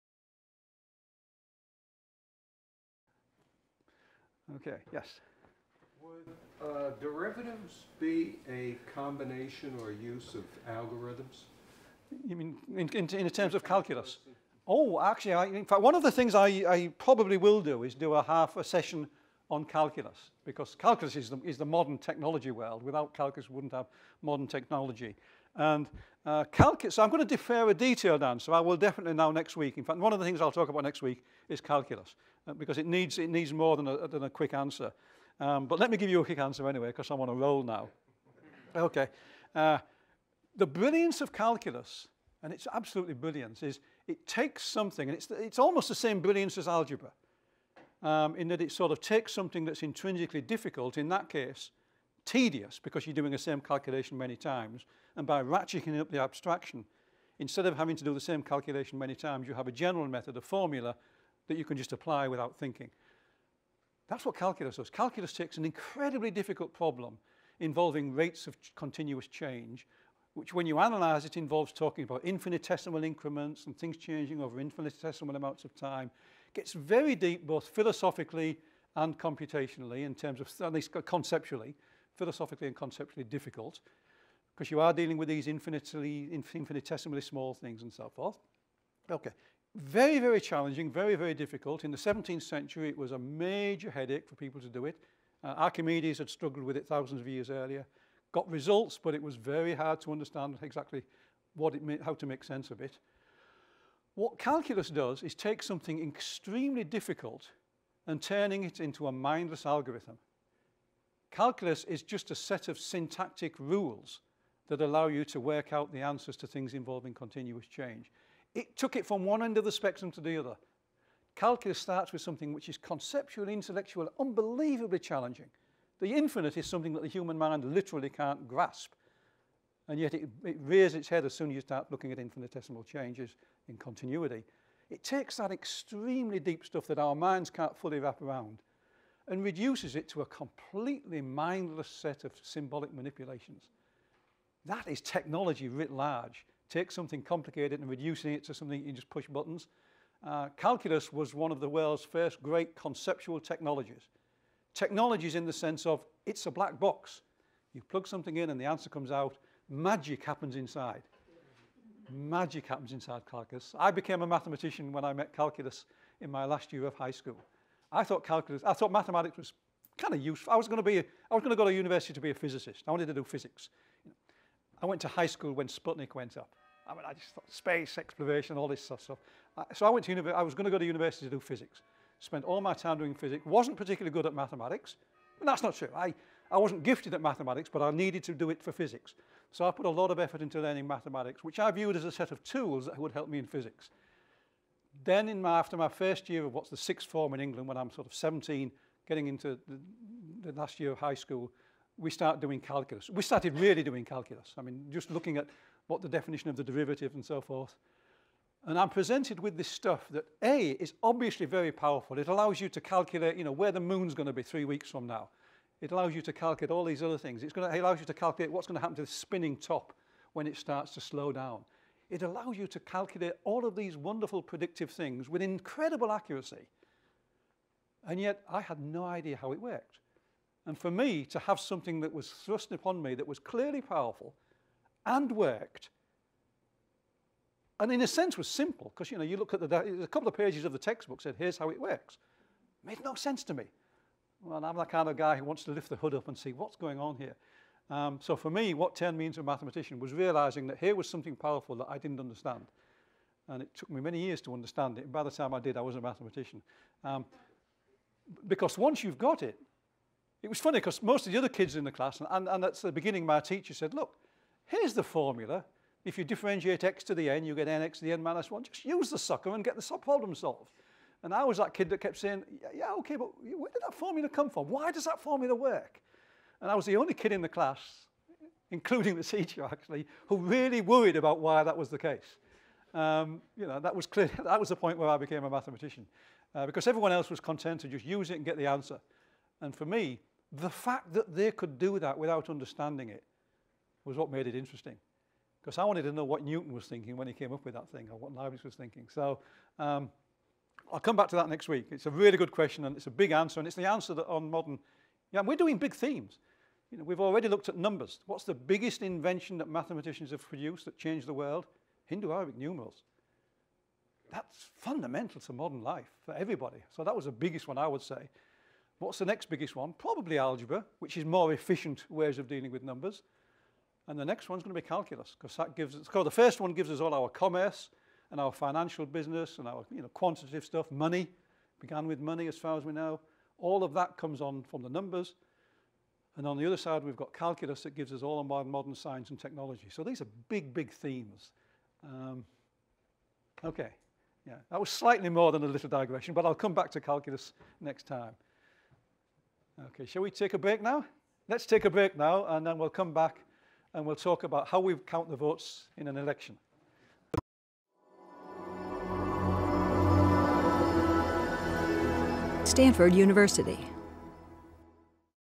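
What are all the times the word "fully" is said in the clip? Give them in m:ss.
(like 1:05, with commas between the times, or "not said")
2:17.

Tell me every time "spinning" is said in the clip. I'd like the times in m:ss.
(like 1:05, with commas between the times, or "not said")
3:39.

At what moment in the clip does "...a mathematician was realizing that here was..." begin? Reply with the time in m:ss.
4:09.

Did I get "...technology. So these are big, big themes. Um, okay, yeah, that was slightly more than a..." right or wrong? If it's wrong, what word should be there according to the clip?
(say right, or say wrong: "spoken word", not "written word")
right.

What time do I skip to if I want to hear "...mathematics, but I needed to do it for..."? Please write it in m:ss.
3:07.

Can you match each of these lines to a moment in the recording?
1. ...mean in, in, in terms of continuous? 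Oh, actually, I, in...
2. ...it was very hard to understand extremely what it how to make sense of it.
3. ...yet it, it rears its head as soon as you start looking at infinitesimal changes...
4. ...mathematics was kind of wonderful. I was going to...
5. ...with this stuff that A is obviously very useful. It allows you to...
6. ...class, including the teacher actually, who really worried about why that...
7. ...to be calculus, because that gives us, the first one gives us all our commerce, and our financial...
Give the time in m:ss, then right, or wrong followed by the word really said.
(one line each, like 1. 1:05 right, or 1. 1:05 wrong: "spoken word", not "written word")
1. 0:12 wrong: "calculus", not "continuous"
2. 1:39 wrong: "exactly", not "extremely"
3. 2:09 right
4. 2:48 wrong: "useful", not "wonderful"
5. 3:29 wrong: "powerful", not "useful"
6. 4:37 right
7. 5:24 right.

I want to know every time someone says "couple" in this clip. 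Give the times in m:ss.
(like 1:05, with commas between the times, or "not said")
4:00.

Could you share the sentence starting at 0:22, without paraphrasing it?
Without calculus, we wouldn't have modern technology.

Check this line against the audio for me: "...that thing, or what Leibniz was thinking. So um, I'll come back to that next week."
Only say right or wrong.
right.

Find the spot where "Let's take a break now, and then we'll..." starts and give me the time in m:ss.
5:51.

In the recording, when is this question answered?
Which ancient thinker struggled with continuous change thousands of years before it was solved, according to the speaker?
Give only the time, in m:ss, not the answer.
1:35.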